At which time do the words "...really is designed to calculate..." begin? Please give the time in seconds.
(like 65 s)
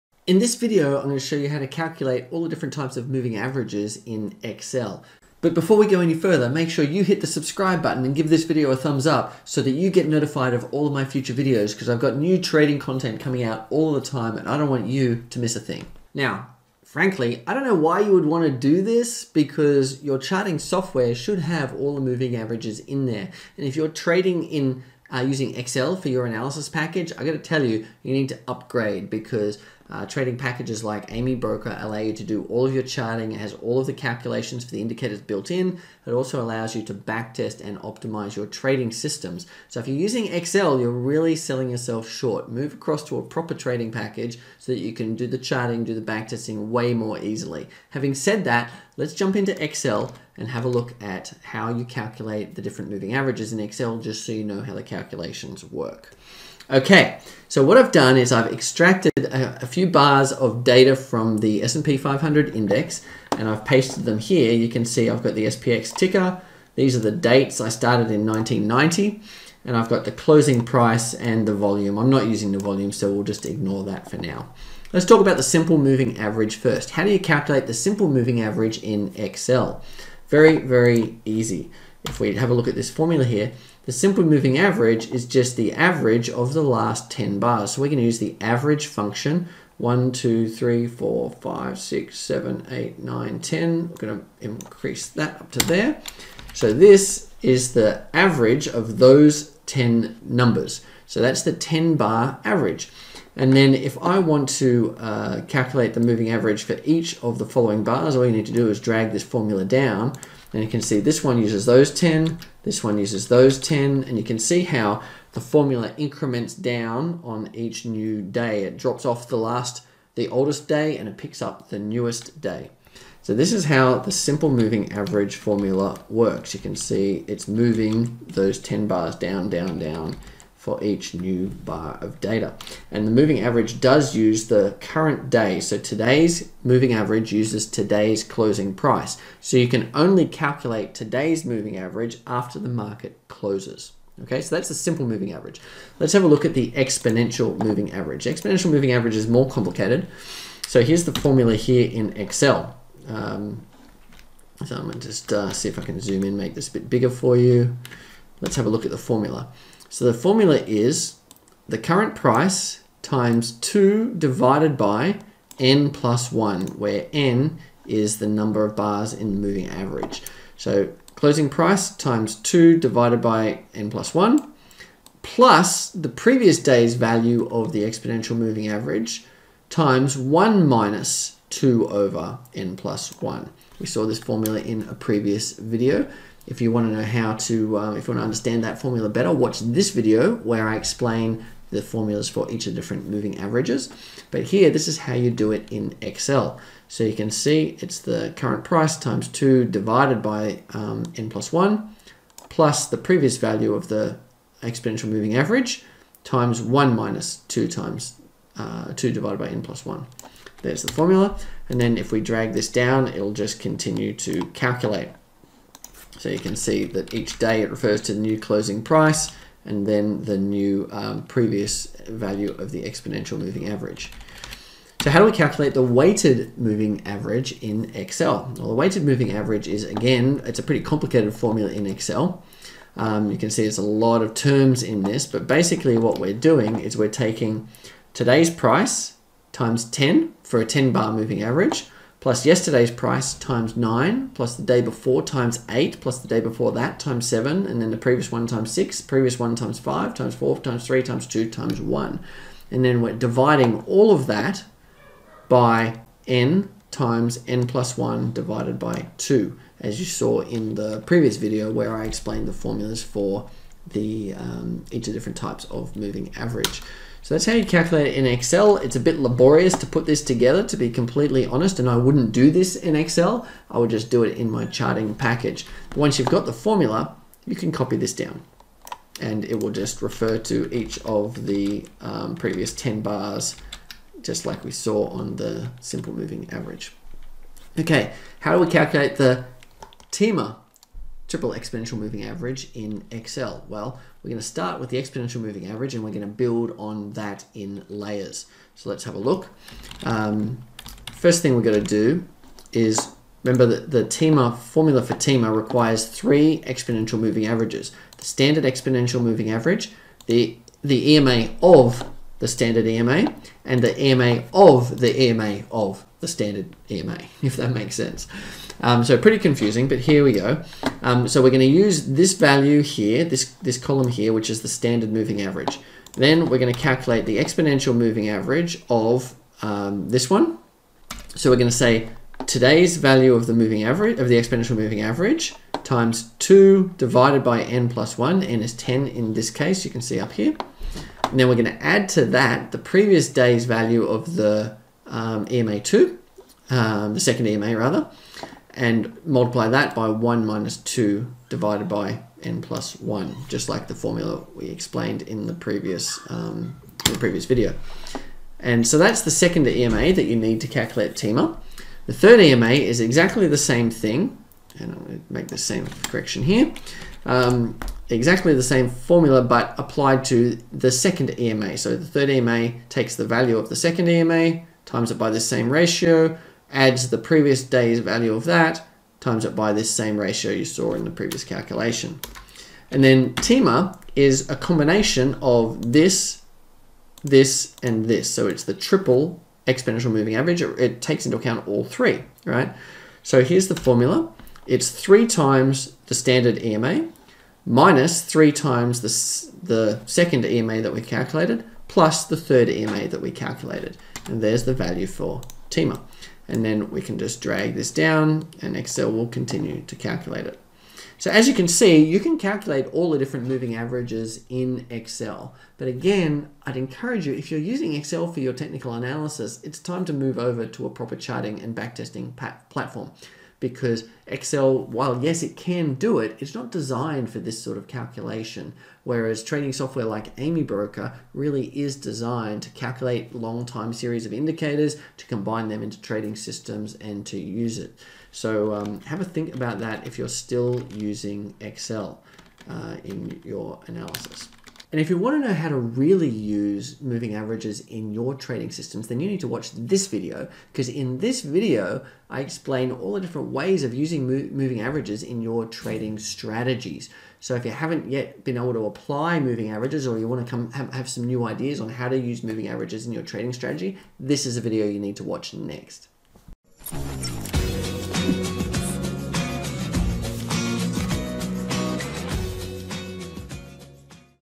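431 s.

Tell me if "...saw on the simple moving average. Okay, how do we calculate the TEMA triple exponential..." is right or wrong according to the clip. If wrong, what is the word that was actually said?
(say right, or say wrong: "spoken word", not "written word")
right.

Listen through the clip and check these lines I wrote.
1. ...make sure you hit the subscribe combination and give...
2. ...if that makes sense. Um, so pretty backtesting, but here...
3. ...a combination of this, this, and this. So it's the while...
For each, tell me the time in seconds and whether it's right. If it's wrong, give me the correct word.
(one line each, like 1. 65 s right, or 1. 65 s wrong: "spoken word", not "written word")
1. 6 s wrong: "button", not "combination"
2. 317 s wrong: "confusing", not "backtesting"
3. 384 s wrong: "triple", not "while".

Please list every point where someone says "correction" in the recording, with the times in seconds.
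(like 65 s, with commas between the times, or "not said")
366 s.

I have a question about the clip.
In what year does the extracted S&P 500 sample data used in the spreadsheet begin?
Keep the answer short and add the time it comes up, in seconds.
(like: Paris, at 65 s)
1990, at 68 s.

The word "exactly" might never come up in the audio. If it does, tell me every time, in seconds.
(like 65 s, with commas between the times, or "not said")
362 s, 368 s.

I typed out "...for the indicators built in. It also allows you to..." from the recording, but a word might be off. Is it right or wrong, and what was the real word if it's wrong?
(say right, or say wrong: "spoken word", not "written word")
right.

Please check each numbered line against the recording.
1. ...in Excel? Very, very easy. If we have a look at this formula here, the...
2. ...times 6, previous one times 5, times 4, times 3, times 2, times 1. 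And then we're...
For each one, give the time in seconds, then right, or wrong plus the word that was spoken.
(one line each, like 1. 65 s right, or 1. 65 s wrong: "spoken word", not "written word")
1. 78 s right
2. 248 s right.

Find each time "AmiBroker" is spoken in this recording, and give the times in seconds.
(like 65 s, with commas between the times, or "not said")
31 s, 430 s.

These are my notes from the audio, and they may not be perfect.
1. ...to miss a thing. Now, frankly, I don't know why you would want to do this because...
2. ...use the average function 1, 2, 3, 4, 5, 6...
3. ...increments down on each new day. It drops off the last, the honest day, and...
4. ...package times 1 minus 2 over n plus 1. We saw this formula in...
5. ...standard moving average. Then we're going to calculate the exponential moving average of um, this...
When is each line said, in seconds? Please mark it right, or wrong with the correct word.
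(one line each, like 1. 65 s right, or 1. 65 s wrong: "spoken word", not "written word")
1. 15 s right
2. 88 s right
3. 115 s wrong: "oldest", not "honest"
4. 178 s wrong: "average", not "package"
5. 324 s right.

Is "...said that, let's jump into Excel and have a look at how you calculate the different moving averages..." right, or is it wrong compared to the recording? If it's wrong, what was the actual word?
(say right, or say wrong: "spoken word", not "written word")
right.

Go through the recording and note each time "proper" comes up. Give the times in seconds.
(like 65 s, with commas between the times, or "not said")
43 s, 420 s.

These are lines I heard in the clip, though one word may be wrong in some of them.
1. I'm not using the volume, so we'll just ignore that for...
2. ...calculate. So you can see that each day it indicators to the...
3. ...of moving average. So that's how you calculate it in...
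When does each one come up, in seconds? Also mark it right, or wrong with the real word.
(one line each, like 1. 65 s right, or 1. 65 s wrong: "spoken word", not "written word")
1. 71 s right
2. 214 s wrong: "refers", not "indicators"
3. 265 s right.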